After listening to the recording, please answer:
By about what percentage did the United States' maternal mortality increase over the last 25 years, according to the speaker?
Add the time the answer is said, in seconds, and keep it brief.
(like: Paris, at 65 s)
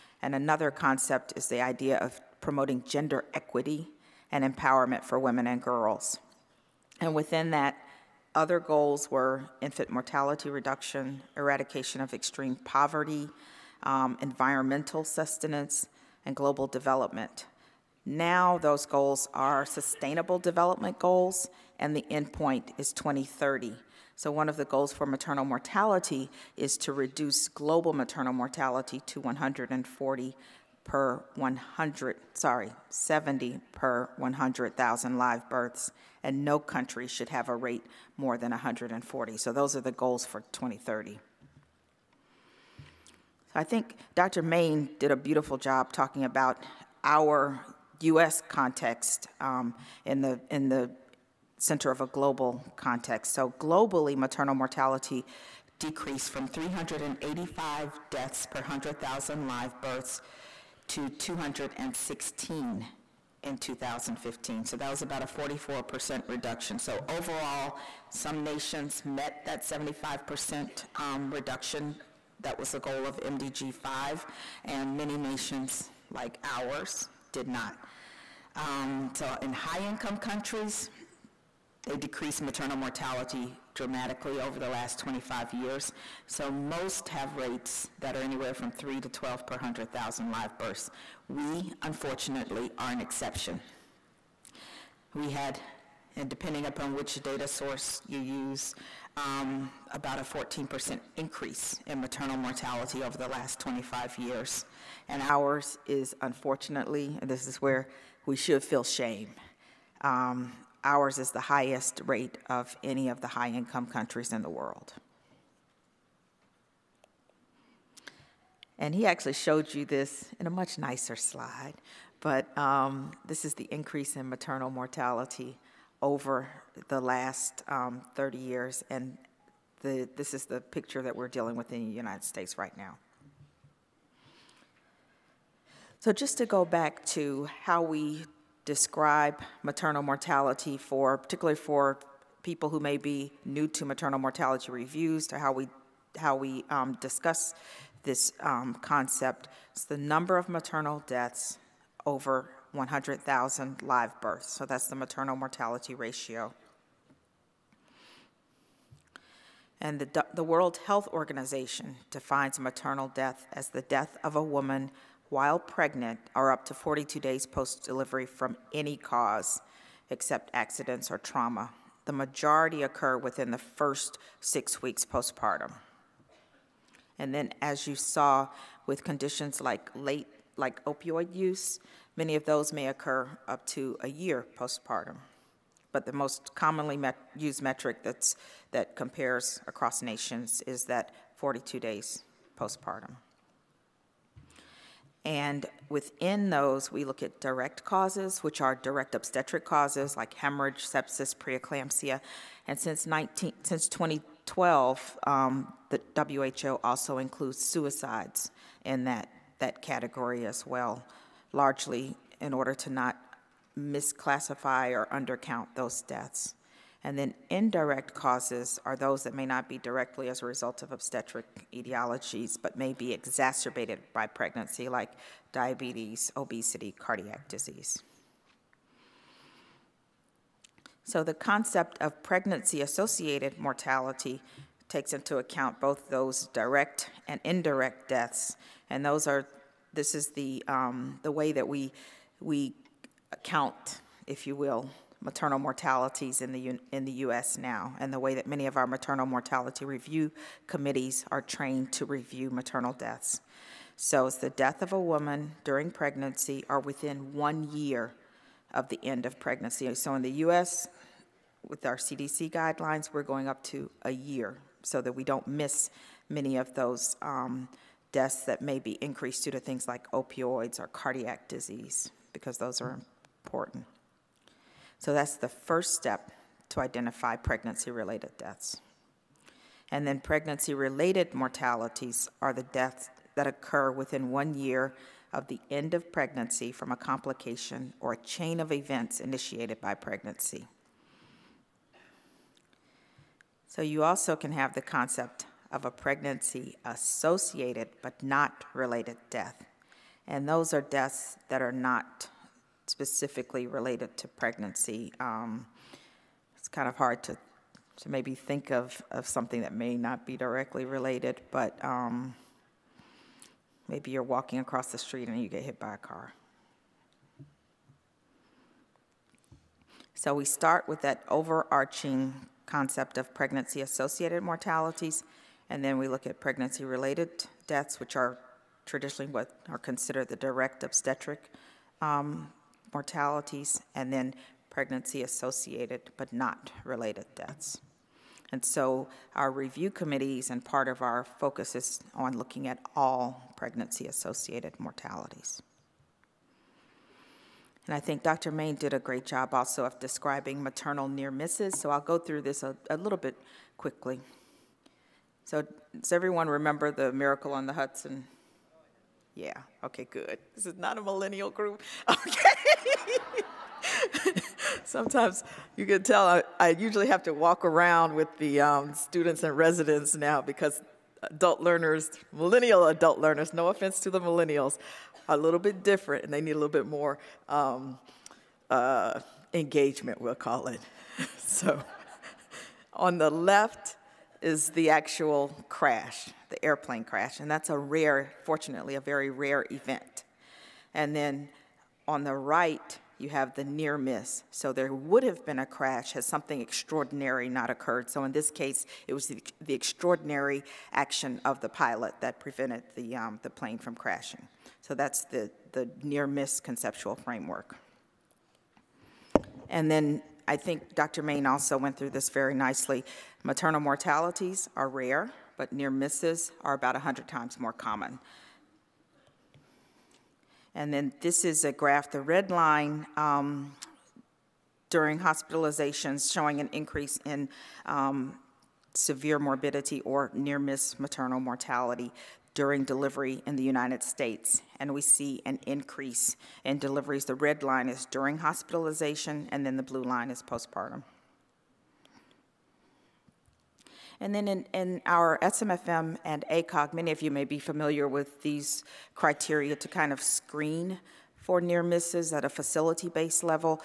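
14%, at 99 s.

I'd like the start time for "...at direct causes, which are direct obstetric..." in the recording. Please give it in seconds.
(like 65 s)
197 s.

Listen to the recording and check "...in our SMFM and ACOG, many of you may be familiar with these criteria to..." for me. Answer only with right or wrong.
right.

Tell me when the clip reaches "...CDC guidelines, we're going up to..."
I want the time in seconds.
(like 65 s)
261 s.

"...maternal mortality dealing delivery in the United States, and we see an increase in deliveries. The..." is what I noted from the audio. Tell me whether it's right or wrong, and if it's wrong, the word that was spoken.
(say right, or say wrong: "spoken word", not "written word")
wrong: "during", not "dealing".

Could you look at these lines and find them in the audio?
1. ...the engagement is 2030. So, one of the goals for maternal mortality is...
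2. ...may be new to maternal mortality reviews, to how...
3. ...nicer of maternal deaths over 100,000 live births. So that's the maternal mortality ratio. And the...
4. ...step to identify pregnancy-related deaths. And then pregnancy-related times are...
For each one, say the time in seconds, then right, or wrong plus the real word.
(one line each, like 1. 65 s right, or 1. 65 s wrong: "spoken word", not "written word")
1. 21 s wrong: "endpoint", not "engagement"
2. 142 s right
3. 149 s wrong: "number", not "nicer"
4. 275 s wrong: "mortalities", not "times".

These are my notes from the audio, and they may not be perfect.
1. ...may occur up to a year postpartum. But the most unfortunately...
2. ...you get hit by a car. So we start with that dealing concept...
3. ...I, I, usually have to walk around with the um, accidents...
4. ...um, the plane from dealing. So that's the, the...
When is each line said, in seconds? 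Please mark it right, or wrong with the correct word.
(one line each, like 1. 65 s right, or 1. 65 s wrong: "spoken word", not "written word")
1. 182 s wrong: "commonly", not "unfortunately"
2. 315 s wrong: "overarching", not "dealing"
3. 366 s wrong: "students", not "accidents"
4. 403 s wrong: "crashing", not "dealing".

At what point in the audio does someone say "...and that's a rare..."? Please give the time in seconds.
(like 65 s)
387 s.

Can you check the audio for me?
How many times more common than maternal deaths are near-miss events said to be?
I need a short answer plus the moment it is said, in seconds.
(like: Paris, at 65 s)
100 times, at 416 s.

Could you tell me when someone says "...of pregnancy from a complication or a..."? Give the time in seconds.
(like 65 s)
285 s.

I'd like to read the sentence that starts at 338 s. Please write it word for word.
And so our review committees and part of our focus is on looking at all pregnancy-associated mortalities.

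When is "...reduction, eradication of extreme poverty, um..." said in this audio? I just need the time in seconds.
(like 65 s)
10 s.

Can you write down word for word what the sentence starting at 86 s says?
So most have rates that are anywhere from 3 to 12 per 100,000 live births.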